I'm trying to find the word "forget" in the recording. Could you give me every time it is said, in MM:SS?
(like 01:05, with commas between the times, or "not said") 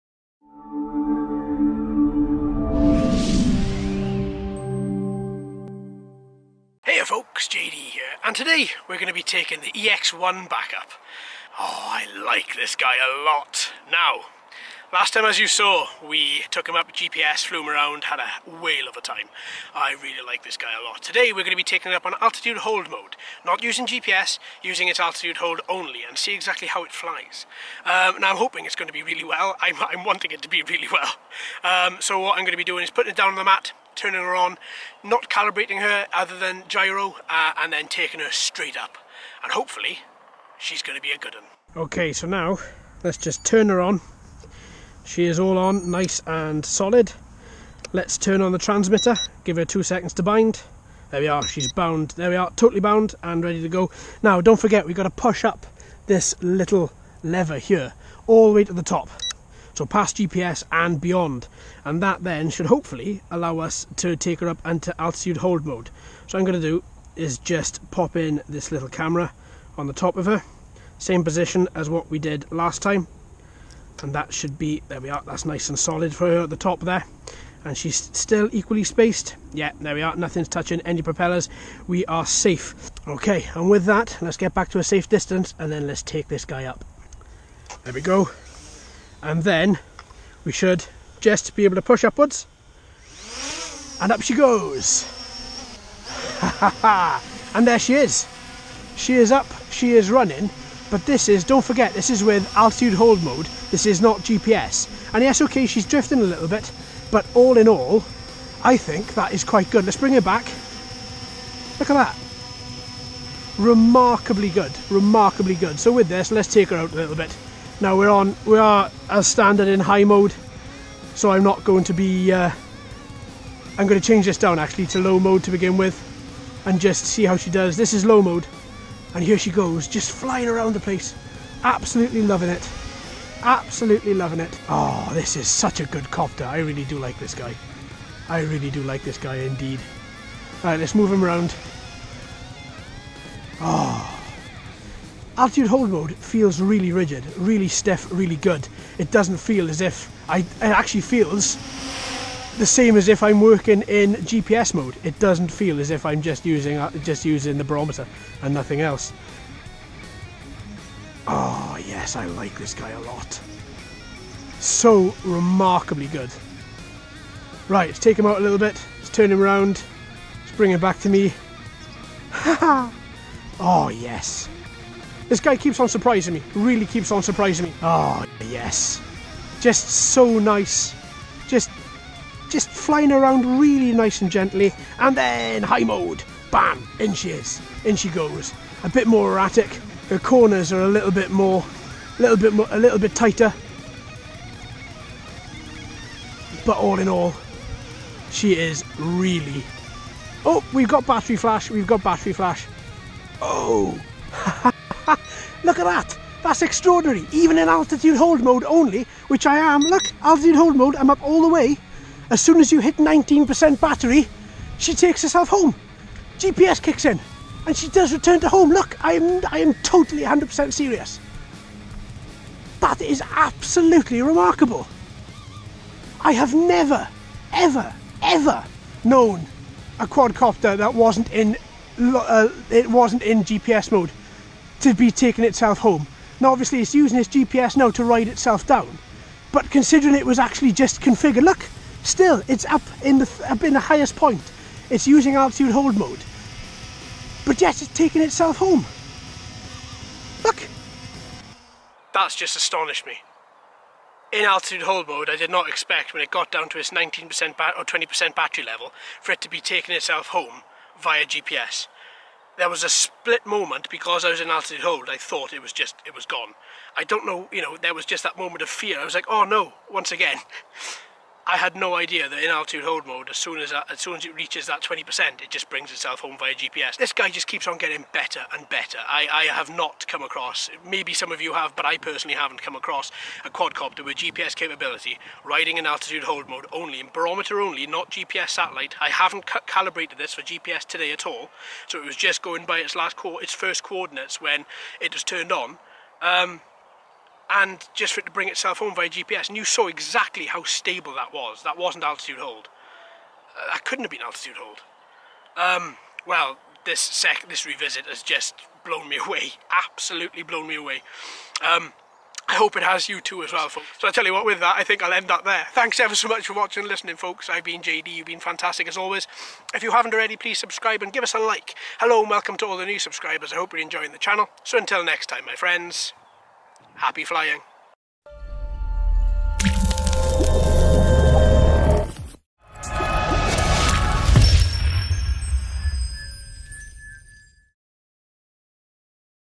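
00:54, 01:41.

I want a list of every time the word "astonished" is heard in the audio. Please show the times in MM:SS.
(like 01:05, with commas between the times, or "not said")
04:12.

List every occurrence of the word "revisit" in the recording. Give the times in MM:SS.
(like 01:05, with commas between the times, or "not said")
05:07.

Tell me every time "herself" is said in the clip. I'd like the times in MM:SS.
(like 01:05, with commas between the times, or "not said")
03:35.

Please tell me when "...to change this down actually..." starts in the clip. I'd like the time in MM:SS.
02:03.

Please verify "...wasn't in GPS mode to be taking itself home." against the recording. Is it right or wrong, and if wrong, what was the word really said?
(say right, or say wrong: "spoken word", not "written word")
right.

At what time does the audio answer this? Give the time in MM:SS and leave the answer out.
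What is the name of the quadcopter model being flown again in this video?
00:09.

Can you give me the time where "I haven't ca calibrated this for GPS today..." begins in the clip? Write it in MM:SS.
04:49.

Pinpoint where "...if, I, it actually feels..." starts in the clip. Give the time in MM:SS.
02:29.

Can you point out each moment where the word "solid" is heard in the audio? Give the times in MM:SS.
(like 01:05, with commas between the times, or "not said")
00:46, 01:15.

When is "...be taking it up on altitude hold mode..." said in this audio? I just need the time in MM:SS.
00:21.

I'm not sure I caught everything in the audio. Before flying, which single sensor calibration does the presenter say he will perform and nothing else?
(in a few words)
gyro.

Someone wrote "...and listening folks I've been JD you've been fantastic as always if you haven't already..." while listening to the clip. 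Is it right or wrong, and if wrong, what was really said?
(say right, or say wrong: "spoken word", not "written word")
right.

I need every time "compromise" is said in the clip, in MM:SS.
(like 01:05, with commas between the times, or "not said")
not said.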